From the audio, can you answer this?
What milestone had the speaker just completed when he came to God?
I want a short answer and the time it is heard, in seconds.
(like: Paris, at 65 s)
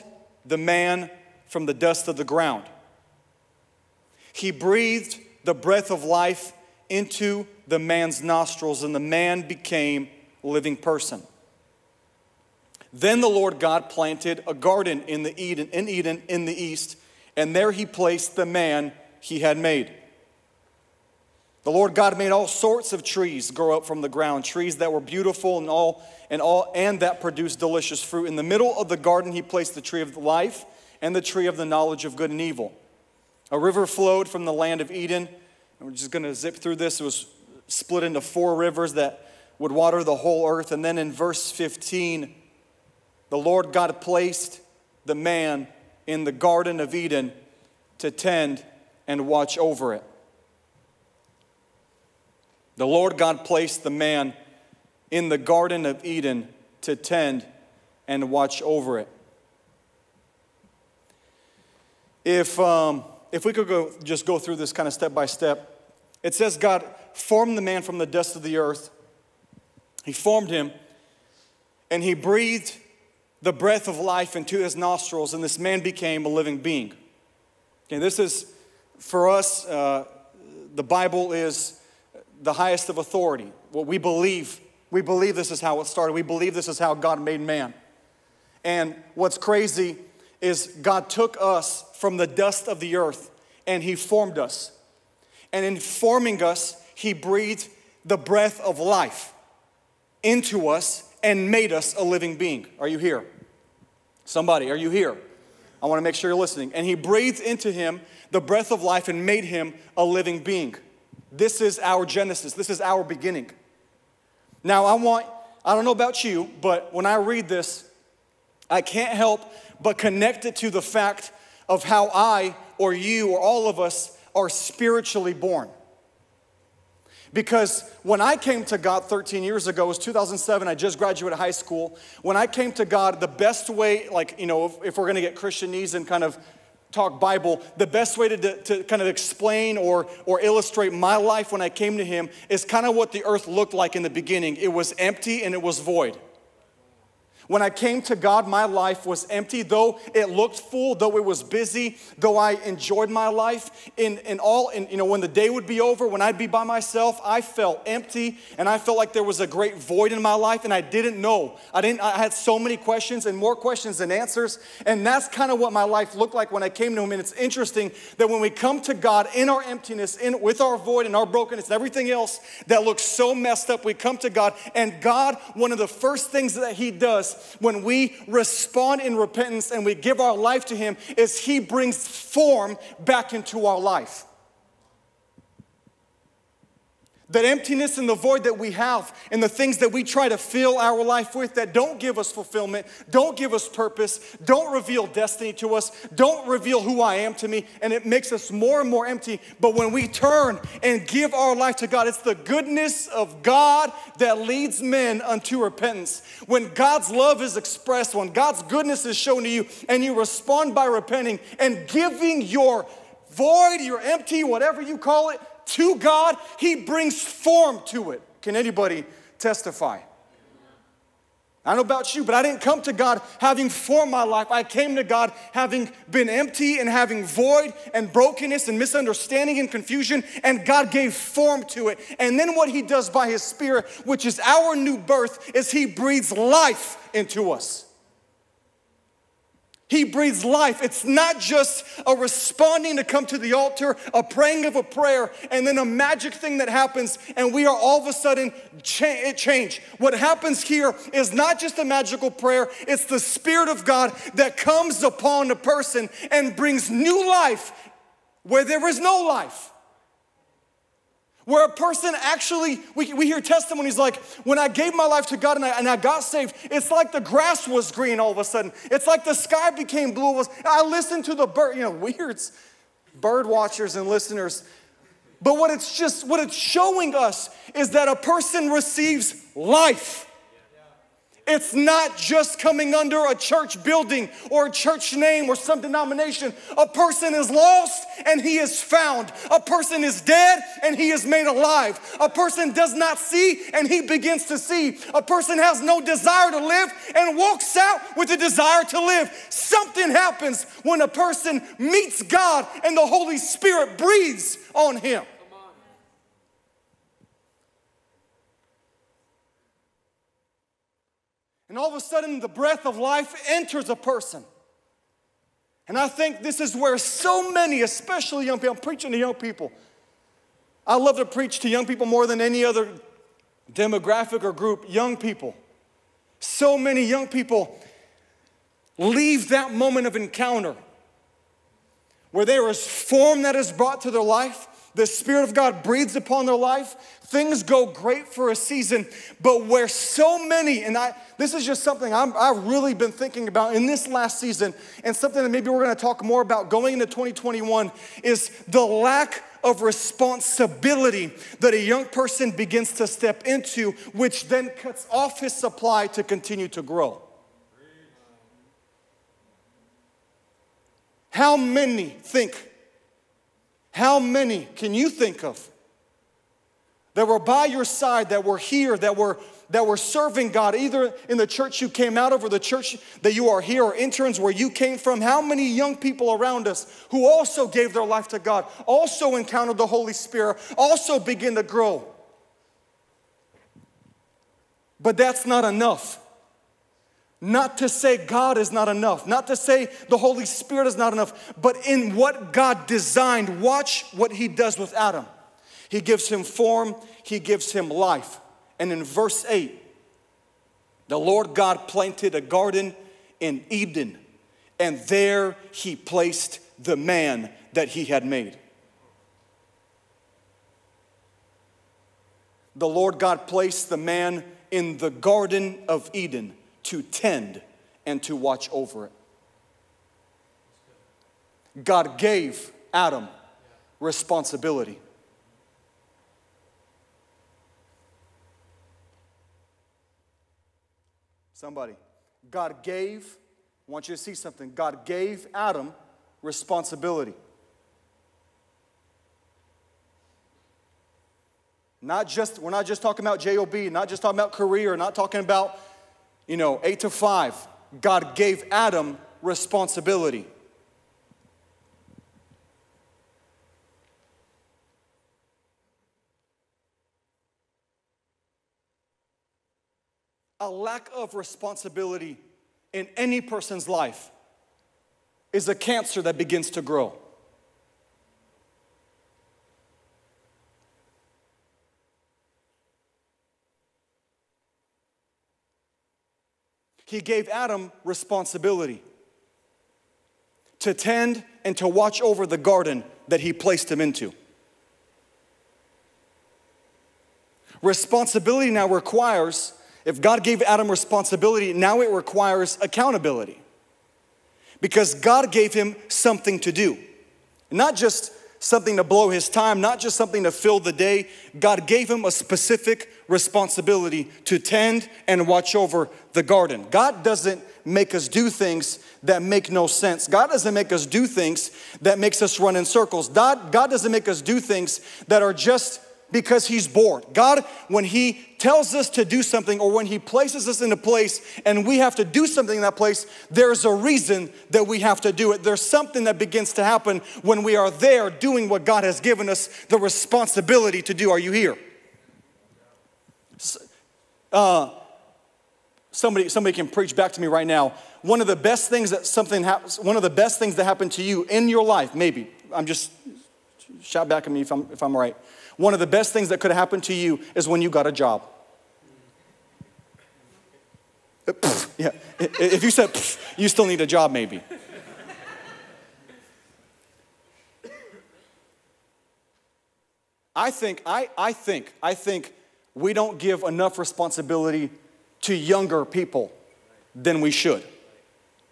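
Graduated high school, at 130 s.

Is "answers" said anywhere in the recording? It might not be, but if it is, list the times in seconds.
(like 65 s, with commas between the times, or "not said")
164 s.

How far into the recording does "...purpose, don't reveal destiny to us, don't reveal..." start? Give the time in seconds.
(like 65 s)
193 s.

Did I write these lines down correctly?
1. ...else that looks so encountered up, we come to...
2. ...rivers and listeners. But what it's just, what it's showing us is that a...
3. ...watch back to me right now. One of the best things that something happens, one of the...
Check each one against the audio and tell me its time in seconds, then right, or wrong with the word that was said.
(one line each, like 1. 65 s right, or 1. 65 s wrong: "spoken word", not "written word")
1. 172 s wrong: "messed", not "encountered"
2. 273 s wrong: "watchers", not "rivers"
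3. 536 s wrong: "preach", not "watch".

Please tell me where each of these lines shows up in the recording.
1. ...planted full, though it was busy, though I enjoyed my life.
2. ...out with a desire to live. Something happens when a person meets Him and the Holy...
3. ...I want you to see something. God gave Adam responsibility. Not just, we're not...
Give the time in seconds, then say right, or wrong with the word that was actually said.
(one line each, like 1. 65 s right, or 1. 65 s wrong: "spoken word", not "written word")
1. 150 s wrong: "looked", not "planted"
2. 297 s wrong: "God", not "Him"
3. 433 s right.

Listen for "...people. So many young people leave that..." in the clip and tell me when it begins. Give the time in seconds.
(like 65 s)
325 s.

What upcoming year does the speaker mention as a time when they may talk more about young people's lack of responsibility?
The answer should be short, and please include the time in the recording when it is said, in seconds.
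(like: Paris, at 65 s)
2021, at 347 s.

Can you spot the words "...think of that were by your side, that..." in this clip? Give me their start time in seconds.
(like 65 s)
365 s.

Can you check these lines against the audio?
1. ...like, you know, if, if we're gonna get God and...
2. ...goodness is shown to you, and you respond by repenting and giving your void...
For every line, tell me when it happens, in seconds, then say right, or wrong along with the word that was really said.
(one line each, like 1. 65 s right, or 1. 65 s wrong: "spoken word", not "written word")
1. 134 s wrong: "Christianese", not "God"
2. 208 s right.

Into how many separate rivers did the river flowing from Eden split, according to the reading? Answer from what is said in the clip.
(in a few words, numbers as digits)
4.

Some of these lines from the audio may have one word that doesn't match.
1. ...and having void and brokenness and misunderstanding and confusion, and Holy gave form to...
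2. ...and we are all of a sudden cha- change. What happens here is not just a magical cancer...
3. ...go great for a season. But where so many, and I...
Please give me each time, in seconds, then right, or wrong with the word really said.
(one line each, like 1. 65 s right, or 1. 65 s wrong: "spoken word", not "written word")
1. 226 s wrong: "God", not "Holy"
2. 247 s wrong: "prayer", not "cancer"
3. 337 s right.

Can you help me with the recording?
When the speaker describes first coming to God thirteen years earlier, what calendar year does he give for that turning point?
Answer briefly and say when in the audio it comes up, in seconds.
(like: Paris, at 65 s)
2007, at 129 s.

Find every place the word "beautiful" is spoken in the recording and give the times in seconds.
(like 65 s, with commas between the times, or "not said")
25 s.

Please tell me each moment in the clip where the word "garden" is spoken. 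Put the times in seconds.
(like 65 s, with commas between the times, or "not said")
14 s, 28 s, 46 s, 55 s, 402 s, 415 s, 482 s, 506 s.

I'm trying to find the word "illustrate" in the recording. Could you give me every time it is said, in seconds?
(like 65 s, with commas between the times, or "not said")
140 s.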